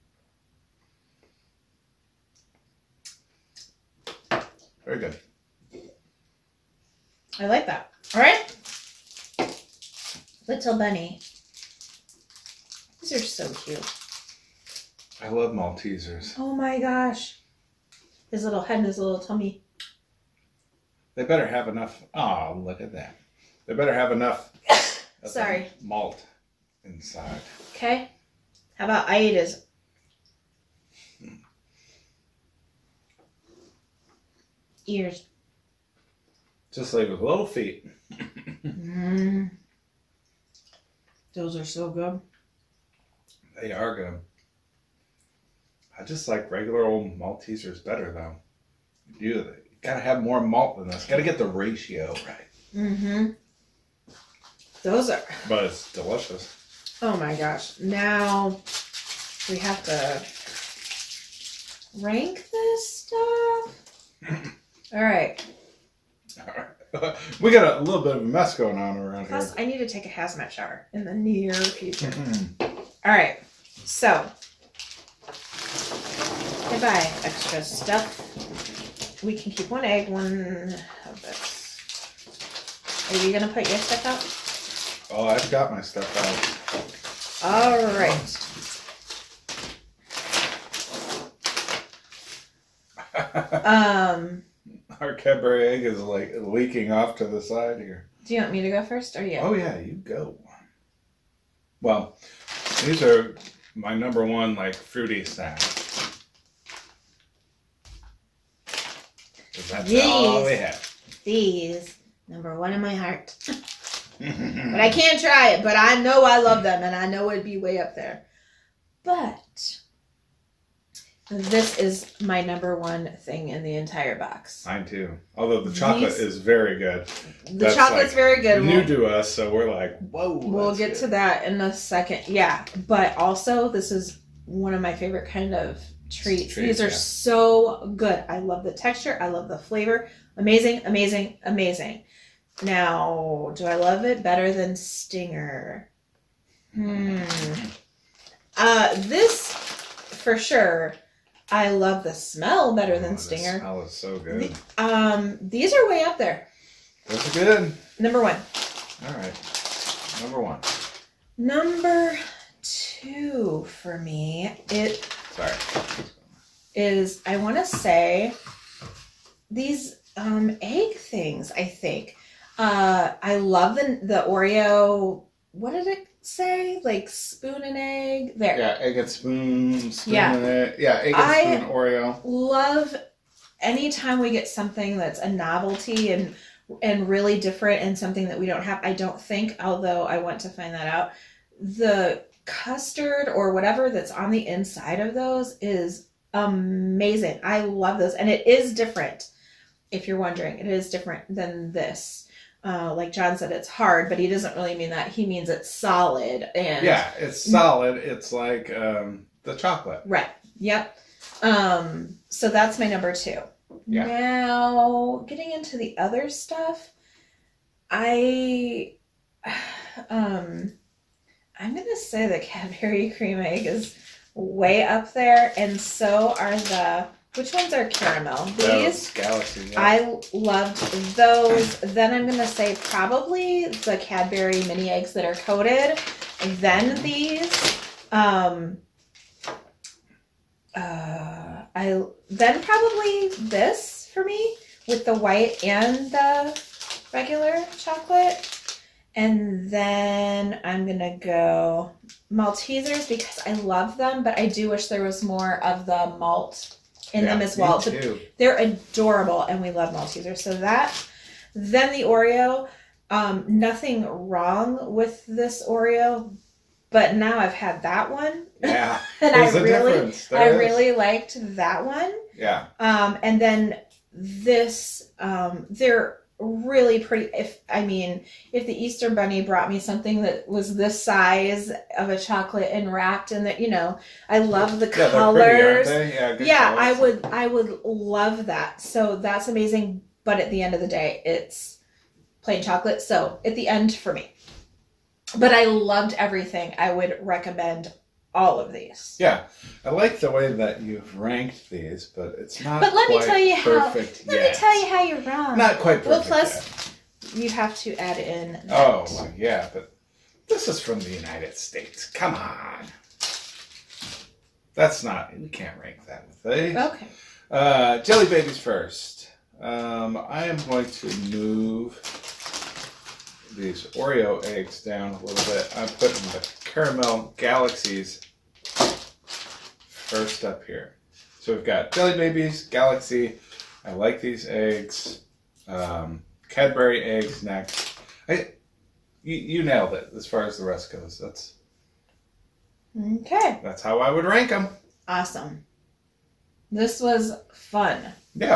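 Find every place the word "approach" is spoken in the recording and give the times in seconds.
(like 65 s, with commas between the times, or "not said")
not said.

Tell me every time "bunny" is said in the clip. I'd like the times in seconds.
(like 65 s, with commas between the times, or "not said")
10 s, 279 s.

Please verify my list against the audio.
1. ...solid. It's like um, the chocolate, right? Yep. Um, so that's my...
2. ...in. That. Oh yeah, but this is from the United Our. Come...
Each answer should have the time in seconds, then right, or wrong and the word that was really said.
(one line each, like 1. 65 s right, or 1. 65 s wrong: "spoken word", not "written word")
1. 207 s right
2. 308 s wrong: "States", not "Our".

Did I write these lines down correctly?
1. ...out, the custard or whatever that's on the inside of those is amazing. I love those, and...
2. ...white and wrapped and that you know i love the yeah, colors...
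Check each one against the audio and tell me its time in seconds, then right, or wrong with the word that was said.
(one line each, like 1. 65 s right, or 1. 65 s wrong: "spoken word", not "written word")
1. 190 s right
2. 282 s wrong: "chocolate", not "white".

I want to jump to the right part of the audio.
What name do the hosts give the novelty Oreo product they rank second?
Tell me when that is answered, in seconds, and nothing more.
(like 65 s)
178 s.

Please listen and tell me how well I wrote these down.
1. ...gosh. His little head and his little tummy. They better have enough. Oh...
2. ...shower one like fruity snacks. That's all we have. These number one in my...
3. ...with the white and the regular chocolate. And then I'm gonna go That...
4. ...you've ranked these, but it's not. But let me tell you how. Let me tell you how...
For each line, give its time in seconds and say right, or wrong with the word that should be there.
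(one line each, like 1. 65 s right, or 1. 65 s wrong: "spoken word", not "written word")
1. 16 s right
2. 103 s wrong: "number", not "shower"
3. 244 s wrong: "Maltesers", not "That"
4. 300 s right.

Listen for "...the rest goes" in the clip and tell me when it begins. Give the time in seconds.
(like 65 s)
340 s.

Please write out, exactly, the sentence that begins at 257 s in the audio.
So they're adorable, and we love Maltesers.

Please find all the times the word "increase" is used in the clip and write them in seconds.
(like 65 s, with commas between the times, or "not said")
not said.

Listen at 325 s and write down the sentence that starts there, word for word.
I'm putting the Caramel Galaxies first up here.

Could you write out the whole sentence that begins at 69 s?
Plus, I need to take a hazmat shower in the near future.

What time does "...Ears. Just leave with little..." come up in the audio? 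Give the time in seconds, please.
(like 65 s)
34 s.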